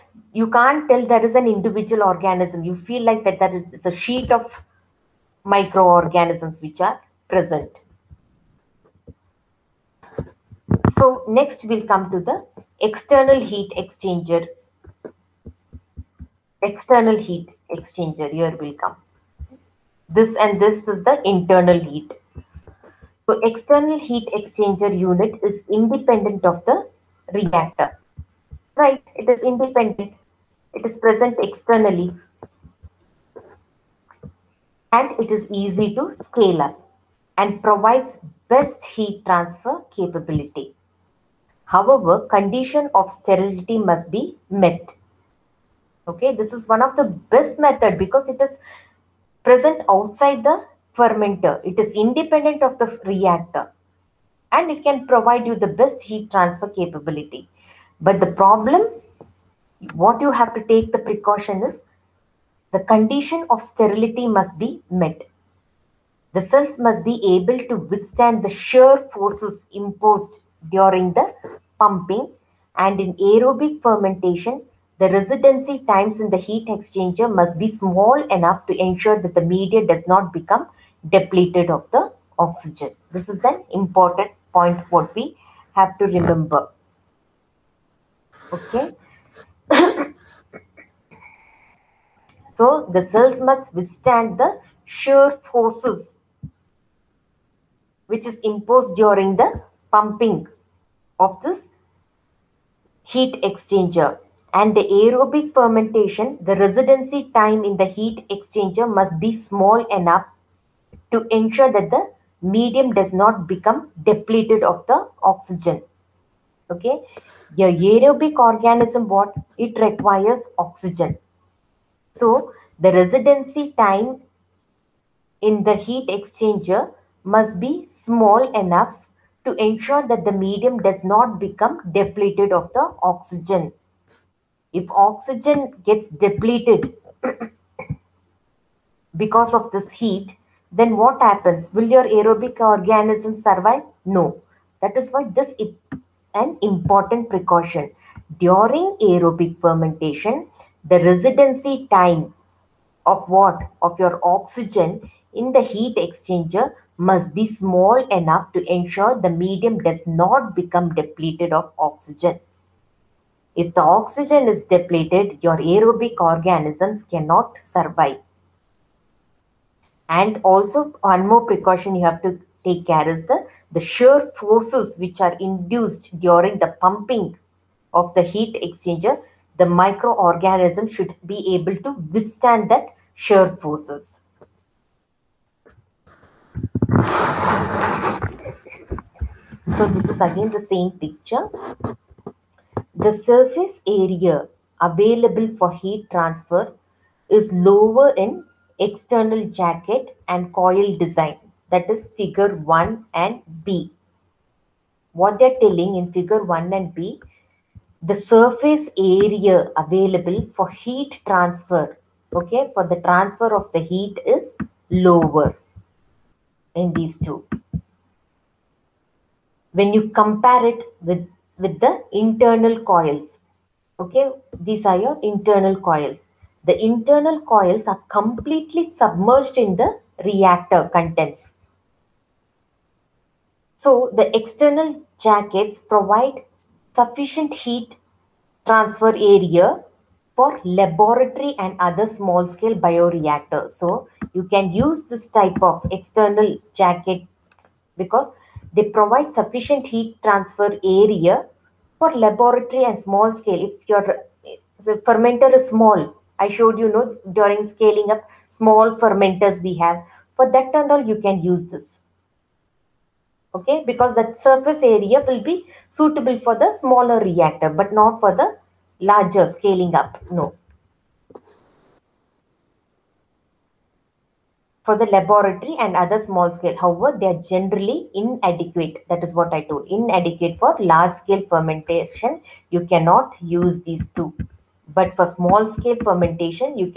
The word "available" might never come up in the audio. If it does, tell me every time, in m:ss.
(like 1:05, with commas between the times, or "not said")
3:14, 3:29.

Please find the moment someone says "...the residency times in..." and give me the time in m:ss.
1:14.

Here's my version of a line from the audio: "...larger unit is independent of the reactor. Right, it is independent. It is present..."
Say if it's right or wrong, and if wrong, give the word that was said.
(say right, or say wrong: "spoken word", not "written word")
wrong: "exchanger", not "larger".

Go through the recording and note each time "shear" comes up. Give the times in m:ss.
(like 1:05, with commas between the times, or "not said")
1:08, 1:34, 2:53, 3:03.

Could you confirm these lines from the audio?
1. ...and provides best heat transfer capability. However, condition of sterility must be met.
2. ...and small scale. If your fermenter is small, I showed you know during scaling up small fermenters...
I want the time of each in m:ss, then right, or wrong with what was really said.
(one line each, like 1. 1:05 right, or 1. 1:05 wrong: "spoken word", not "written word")
1. 0:37 right
2. 4:12 right.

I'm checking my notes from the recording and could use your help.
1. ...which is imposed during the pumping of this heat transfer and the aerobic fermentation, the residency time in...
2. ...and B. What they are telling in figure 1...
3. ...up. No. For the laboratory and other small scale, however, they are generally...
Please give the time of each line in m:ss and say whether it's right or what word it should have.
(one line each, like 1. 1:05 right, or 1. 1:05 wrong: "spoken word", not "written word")
1. 1:38 wrong: "exchanger", not "transfer"
2. 3:23 right
3. 4:29 right.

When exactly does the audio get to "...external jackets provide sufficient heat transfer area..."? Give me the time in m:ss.
3:54.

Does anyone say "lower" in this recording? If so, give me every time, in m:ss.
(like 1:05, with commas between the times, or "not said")
3:17, 3:34.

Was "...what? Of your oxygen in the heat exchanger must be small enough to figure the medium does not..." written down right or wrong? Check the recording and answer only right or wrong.
wrong.